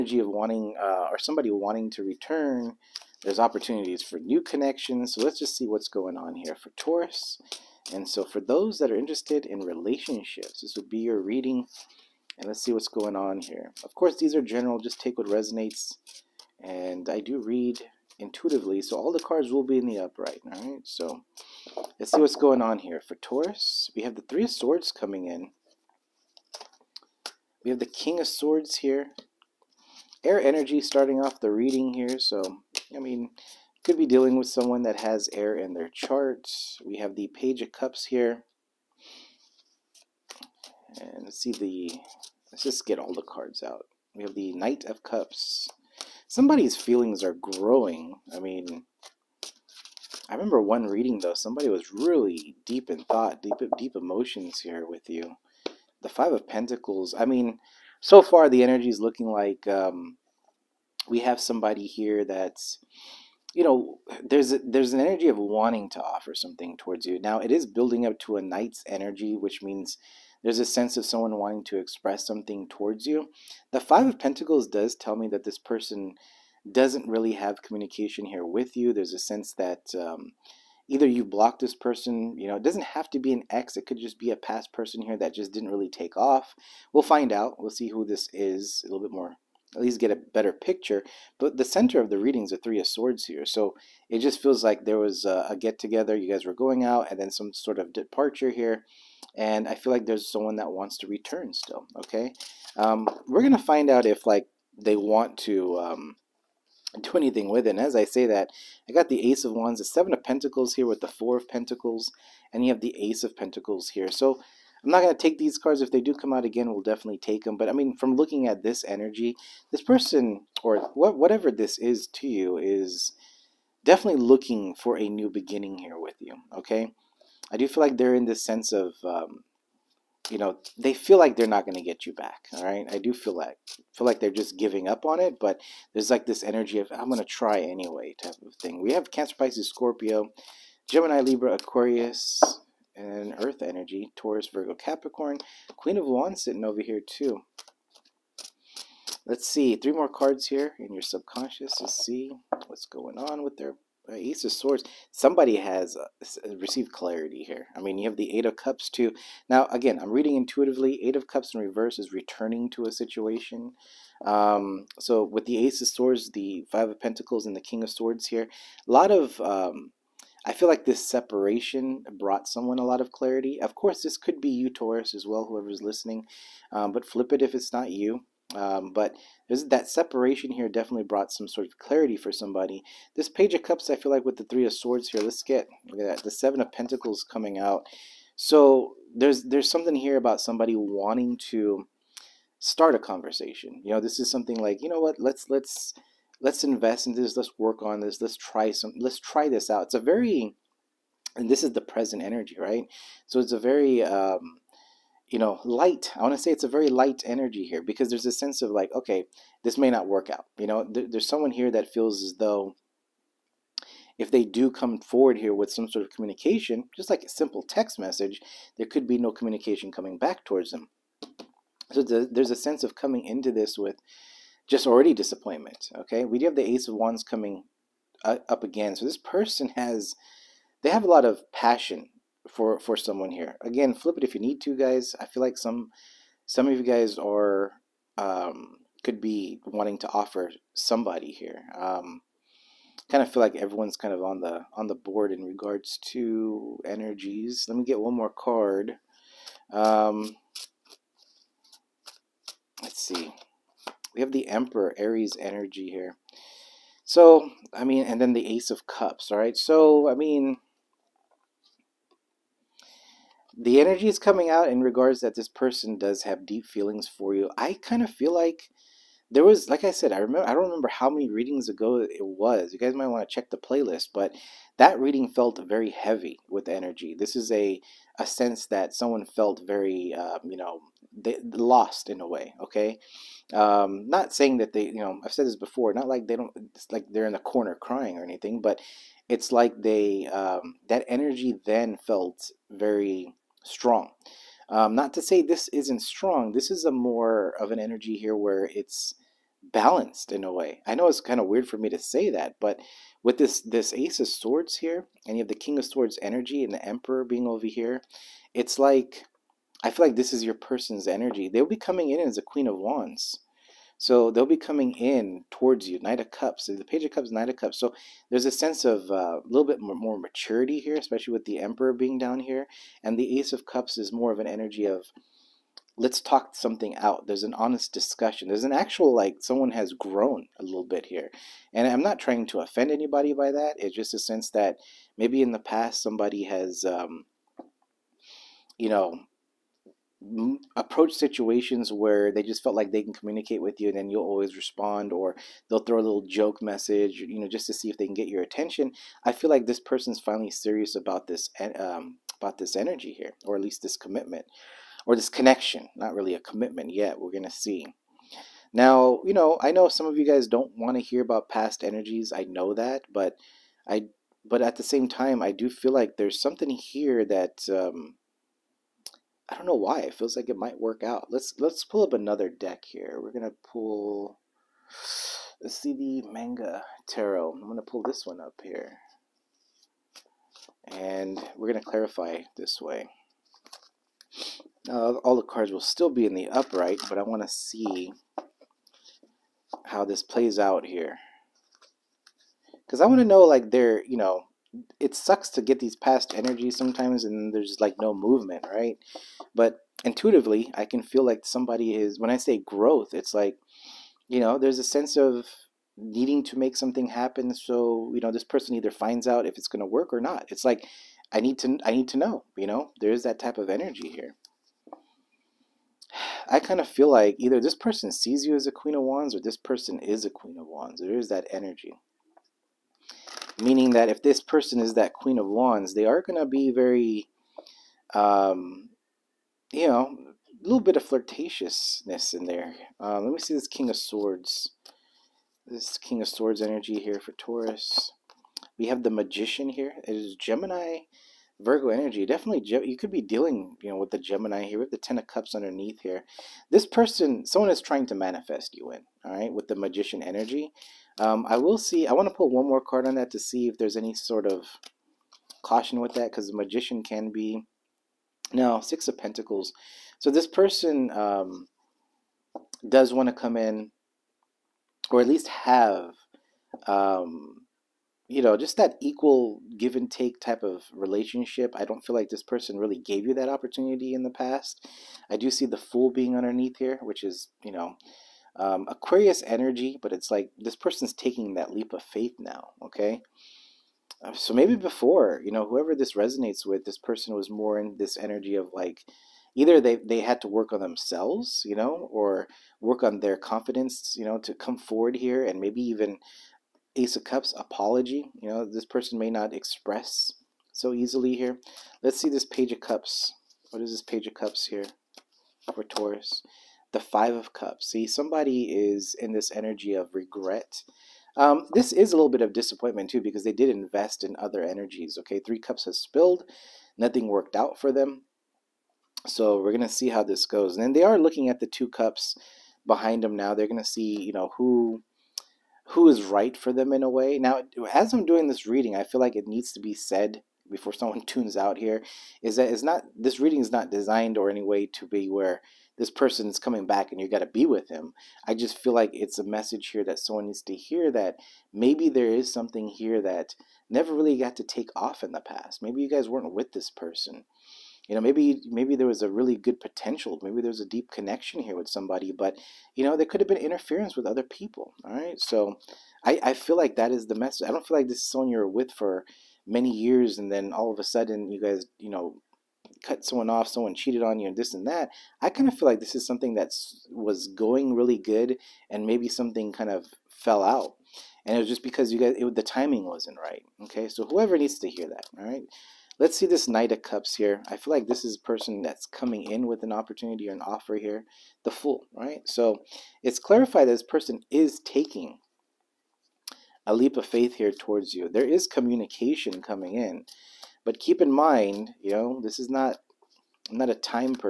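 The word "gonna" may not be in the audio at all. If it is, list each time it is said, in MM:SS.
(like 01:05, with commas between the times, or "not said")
05:57, 06:13, 06:17, 06:21.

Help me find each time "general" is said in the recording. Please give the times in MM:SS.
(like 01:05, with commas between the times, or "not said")
00:14.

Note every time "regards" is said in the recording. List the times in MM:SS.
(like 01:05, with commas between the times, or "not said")
04:05, 04:24.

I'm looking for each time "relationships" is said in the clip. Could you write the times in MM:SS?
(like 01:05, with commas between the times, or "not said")
00:09, 07:50.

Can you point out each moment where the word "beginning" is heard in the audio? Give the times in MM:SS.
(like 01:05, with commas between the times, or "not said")
02:05.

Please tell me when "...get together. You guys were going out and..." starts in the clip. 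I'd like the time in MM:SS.
01:35.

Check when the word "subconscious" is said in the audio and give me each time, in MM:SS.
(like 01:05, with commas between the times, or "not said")
02:31.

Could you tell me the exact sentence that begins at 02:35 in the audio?
Somebody has uh, received clarity here.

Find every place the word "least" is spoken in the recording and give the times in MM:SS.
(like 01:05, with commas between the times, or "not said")
01:29, 05:53, 07:45.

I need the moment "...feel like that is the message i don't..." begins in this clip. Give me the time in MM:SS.
09:16.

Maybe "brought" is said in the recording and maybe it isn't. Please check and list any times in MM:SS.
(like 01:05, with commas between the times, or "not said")
02:52, 03:01.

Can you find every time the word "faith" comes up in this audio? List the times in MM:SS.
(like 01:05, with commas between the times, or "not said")
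08:02, 09:47.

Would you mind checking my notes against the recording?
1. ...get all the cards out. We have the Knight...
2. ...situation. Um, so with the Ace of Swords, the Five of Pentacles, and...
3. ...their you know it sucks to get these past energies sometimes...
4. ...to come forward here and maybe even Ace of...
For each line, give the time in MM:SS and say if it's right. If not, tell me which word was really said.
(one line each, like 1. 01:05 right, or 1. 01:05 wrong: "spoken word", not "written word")
1. 00:42 right
2. 02:42 right
3. 06:33 right
4. 08:14 right.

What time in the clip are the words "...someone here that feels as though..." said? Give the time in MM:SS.
03:31.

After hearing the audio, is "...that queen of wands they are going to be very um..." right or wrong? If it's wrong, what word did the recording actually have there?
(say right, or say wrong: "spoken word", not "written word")
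right.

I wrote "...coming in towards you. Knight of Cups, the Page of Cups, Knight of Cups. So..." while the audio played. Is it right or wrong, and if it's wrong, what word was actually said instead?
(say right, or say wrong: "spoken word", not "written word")
right.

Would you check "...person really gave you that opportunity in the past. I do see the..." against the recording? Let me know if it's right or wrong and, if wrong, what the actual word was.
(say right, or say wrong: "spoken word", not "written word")
right.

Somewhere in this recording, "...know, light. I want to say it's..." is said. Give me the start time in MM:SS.
03:25.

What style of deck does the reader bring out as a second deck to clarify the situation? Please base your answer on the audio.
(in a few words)
Manga tarot.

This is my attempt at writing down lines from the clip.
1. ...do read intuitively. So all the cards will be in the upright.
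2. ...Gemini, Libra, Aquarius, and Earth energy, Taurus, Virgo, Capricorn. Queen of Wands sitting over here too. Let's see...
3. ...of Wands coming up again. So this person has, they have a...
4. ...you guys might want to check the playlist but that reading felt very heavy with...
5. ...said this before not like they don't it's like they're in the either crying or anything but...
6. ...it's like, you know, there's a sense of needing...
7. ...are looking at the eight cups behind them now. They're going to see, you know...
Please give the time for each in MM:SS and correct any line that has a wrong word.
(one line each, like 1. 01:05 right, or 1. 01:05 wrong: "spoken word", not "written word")
1. 00:17 right
2. 02:20 right
3. 03:46 right
4. 04:32 right
5. 04:45 wrong: "corner", not "either"
6. 06:43 right
7. 08:41 wrong: "two", not "eight".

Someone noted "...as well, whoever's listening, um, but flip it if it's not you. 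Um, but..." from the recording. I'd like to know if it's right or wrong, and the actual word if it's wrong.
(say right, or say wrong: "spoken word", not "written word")
right.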